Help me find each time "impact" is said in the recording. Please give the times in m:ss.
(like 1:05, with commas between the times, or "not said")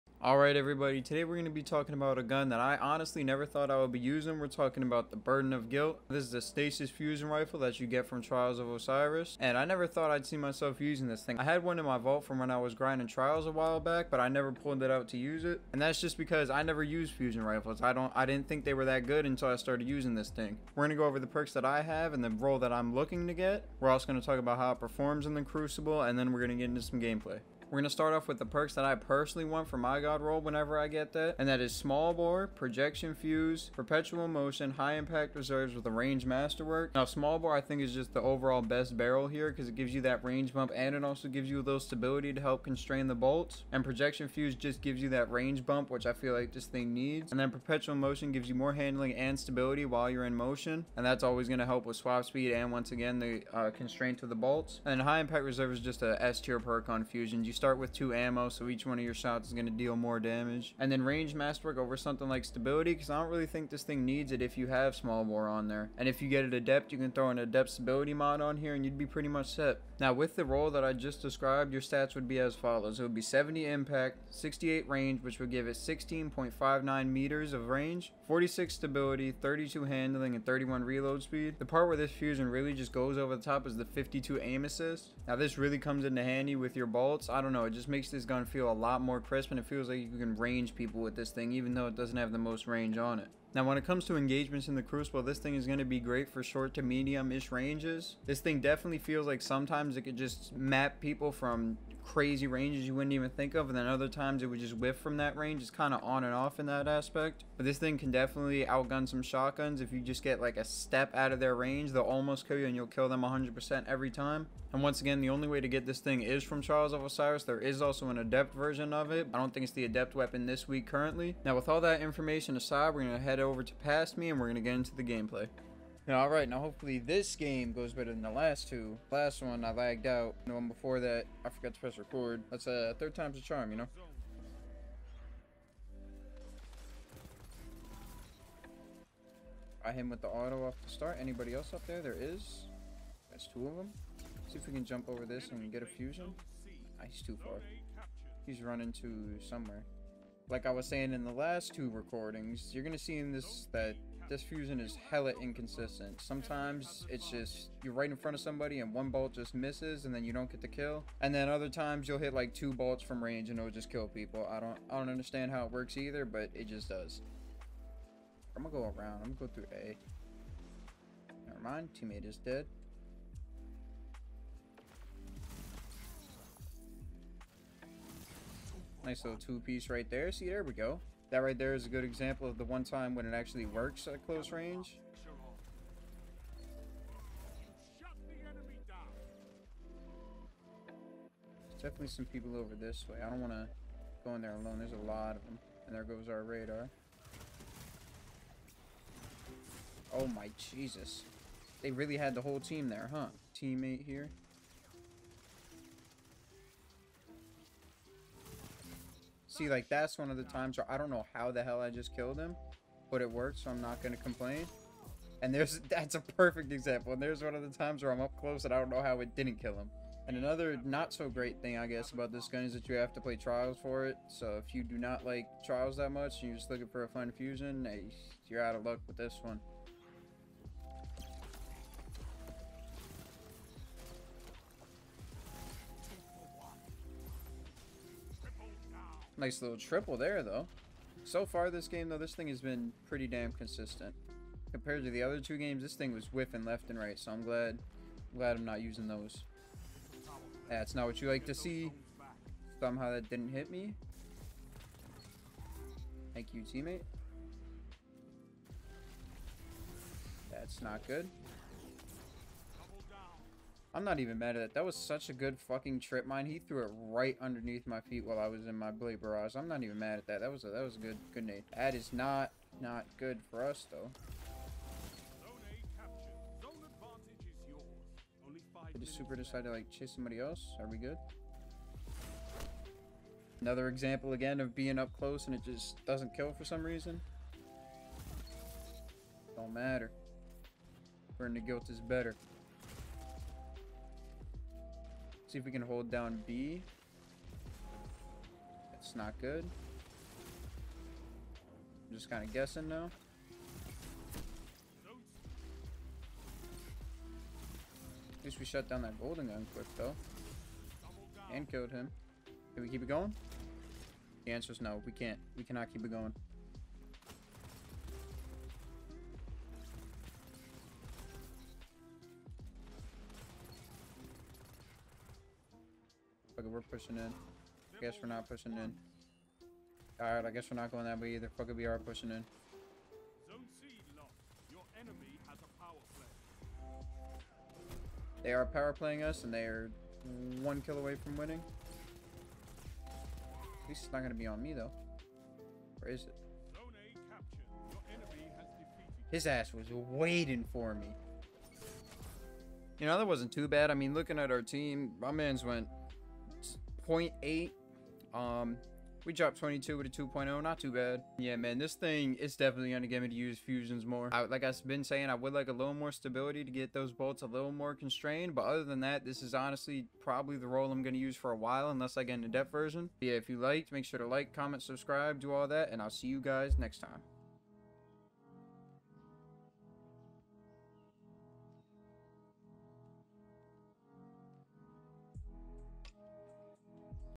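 0:34, 0:55, 1:13.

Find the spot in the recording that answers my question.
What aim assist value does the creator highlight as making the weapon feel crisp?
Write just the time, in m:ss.
1:23.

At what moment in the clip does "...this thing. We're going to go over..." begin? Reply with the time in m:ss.
0:20.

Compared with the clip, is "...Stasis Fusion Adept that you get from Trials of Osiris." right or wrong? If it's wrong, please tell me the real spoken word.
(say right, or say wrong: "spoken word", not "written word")
wrong: "Rifle", not "Adept".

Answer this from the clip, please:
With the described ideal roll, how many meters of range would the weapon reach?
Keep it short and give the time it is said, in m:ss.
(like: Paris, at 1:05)
16.59, at 1:15.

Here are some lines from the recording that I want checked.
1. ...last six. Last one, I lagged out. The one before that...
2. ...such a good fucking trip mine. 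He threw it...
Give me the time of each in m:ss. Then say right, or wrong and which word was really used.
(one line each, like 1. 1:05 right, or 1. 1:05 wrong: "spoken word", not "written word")
1. 2:08 wrong: "two", not "six"
2. 4:24 right.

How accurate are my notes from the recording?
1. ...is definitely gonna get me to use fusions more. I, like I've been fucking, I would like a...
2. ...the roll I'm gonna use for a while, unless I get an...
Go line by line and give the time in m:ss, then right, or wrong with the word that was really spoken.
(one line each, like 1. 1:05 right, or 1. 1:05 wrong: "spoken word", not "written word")
1. 6:02 wrong: "saying", not "fucking"
2. 6:10 right.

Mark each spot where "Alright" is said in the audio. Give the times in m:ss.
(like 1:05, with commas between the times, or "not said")
0:00, 5:30.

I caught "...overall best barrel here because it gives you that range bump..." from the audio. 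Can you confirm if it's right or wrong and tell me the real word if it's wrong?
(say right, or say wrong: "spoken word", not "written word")
right.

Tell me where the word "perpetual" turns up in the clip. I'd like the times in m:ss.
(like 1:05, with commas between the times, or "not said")
0:33, 0:47.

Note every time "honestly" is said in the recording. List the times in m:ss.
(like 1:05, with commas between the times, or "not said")
0:02, 6:09.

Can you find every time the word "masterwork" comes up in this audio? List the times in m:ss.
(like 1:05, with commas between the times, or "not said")
0:36, 1:01.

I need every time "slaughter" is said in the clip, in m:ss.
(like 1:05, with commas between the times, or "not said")
not said.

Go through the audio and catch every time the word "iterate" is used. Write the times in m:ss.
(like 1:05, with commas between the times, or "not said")
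not said.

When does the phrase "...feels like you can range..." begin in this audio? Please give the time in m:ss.
1:29.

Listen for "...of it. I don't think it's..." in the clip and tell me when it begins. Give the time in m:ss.
1:58.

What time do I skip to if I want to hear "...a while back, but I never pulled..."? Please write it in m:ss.
0:13.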